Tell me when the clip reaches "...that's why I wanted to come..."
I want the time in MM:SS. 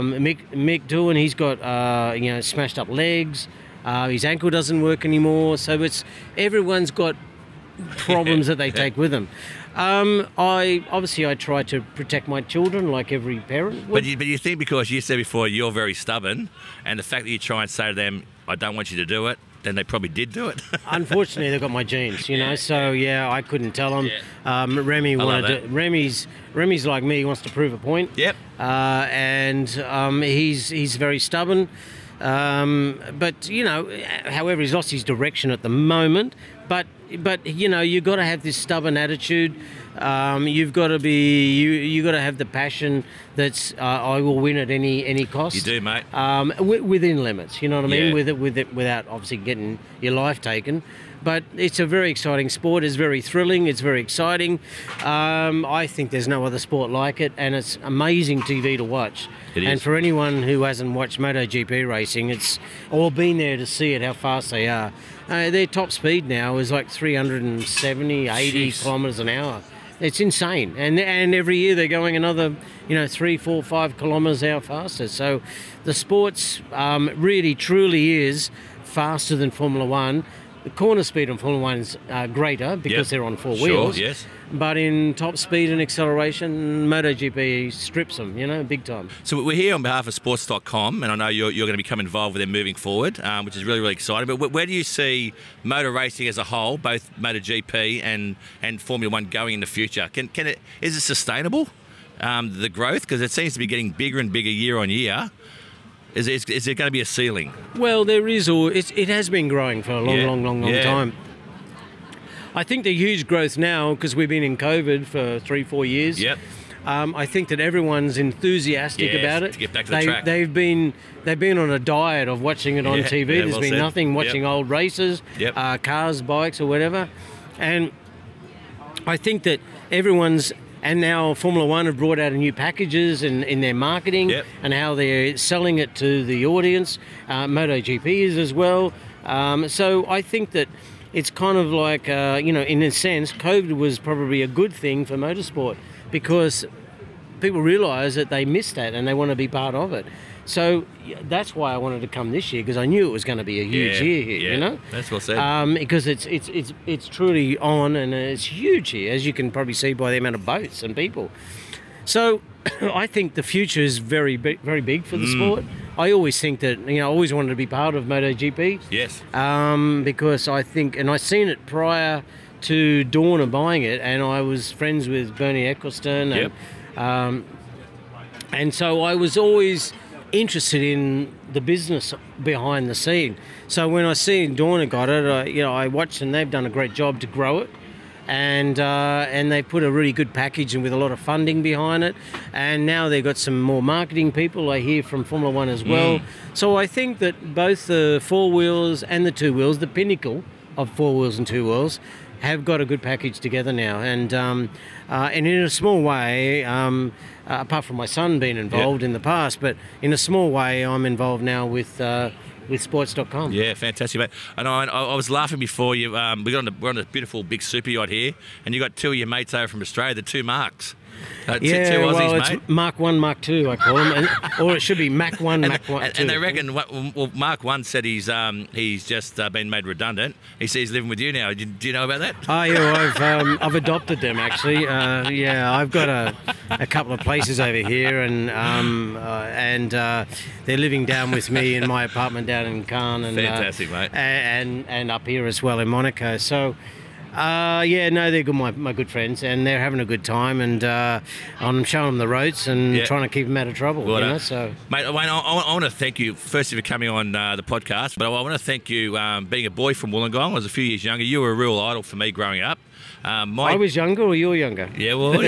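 02:31.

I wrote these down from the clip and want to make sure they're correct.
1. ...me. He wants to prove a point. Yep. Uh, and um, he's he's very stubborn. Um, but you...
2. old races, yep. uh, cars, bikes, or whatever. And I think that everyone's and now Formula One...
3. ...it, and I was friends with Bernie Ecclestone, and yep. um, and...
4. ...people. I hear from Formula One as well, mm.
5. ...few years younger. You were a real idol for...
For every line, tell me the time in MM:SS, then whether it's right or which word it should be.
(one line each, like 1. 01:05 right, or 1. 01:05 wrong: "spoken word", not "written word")
1. 00:27 right
2. 02:04 right
3. 02:53 right
4. 03:14 right
5. 04:20 right.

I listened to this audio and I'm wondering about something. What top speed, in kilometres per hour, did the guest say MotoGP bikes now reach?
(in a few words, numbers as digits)
370.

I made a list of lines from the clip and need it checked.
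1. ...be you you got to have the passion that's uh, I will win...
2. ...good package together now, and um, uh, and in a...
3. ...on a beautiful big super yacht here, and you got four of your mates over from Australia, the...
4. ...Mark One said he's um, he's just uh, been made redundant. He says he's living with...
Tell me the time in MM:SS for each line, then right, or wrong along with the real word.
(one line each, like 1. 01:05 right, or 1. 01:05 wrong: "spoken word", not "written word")
1. 00:40 right
2. 03:22 right
3. 03:36 wrong: "two", not "four"
4. 03:47 right.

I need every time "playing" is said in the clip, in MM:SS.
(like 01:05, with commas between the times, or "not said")
not said.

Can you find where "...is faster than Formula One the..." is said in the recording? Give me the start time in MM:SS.
01:18.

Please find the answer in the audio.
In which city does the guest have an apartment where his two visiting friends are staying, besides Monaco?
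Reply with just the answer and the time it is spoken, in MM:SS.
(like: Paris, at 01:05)
Cannes, at 04:02.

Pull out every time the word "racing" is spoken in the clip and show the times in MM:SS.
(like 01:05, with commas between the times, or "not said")
01:01, 01:35.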